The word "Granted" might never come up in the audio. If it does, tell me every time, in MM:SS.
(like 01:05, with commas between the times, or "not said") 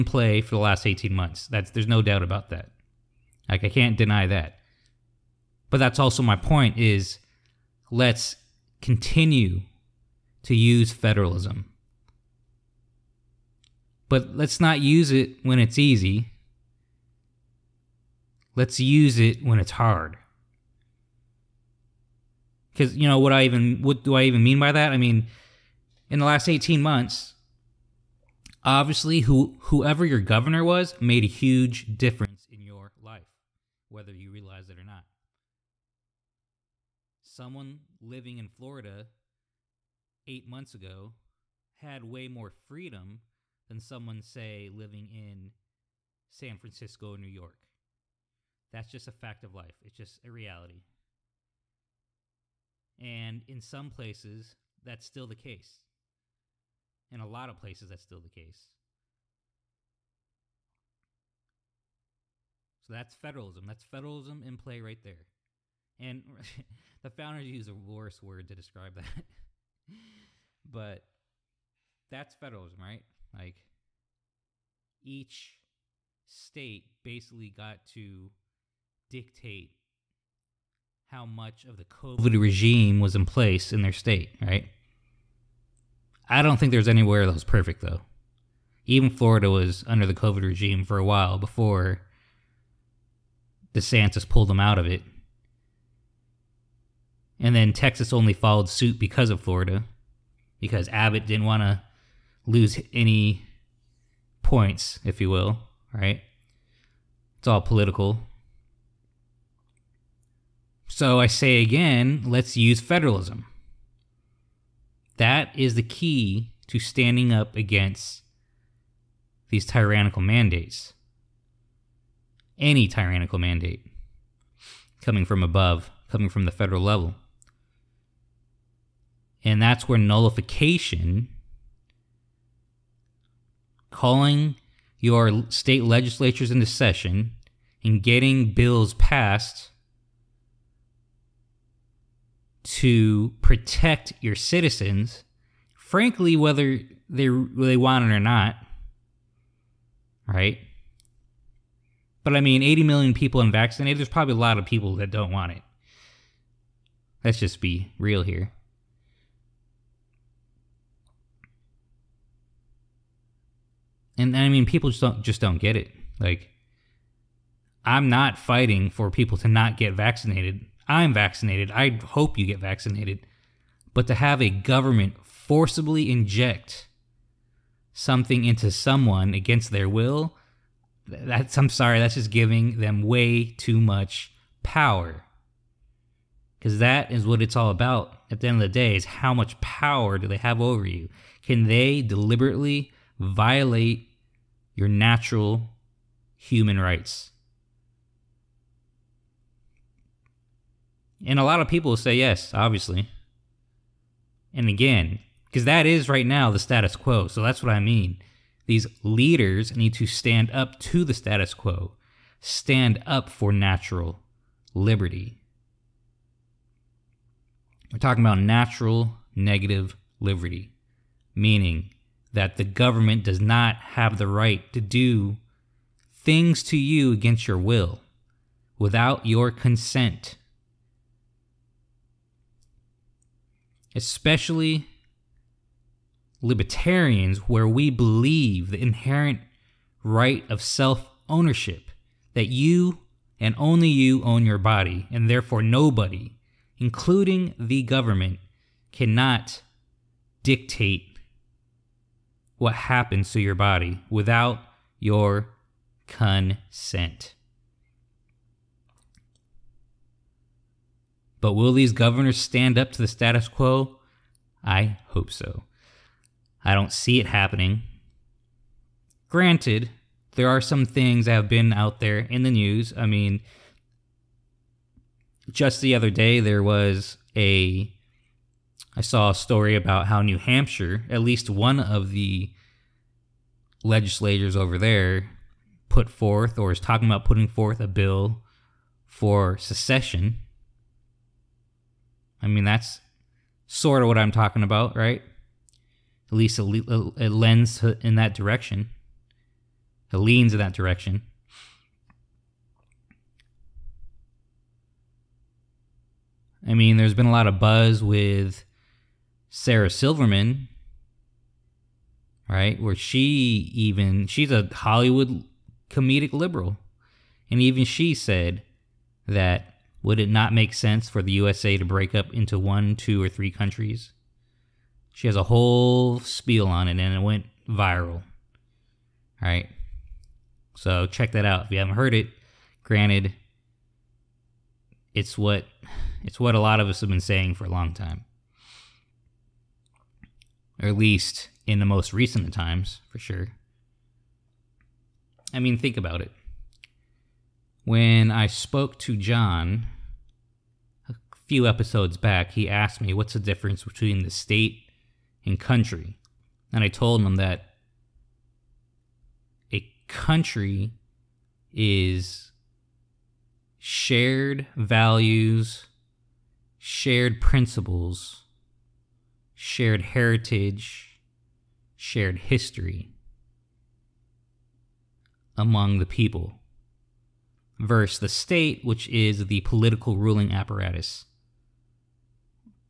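04:29, 05:32.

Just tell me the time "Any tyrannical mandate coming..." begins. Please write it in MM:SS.
02:02.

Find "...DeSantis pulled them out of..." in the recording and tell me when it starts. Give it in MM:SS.
01:33.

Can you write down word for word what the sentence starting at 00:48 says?
That's just a fact of life, it's just a reality.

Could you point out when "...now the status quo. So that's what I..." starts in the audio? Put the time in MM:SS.
03:26.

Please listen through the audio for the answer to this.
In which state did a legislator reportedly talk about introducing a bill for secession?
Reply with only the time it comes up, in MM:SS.
04:40.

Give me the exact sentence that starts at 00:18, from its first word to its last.
Let's use it when it's hard.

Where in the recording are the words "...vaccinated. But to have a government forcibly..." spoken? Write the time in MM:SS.
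02:52.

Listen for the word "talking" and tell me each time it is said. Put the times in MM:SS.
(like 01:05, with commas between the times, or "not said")
03:37, 04:46, 04:54.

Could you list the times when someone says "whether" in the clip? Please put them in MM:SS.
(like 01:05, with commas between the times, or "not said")
00:33, 02:26.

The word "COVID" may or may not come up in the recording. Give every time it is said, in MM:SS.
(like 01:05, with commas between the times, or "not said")
01:21, 01:30.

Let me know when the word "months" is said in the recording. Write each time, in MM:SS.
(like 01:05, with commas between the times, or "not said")
00:01, 00:26, 00:40.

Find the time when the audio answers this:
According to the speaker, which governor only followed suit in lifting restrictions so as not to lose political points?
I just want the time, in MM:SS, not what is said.
01:40.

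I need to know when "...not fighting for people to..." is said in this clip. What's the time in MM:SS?
02:48.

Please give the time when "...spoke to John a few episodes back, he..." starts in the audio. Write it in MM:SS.
05:48.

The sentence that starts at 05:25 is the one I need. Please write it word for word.
She has a whole spiel on it and it went viral.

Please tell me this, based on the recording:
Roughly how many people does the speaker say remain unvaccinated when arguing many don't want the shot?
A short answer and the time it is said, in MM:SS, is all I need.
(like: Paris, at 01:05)
80 million, at 02:32.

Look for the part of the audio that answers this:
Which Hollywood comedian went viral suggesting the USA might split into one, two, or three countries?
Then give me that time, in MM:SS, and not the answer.
05:09.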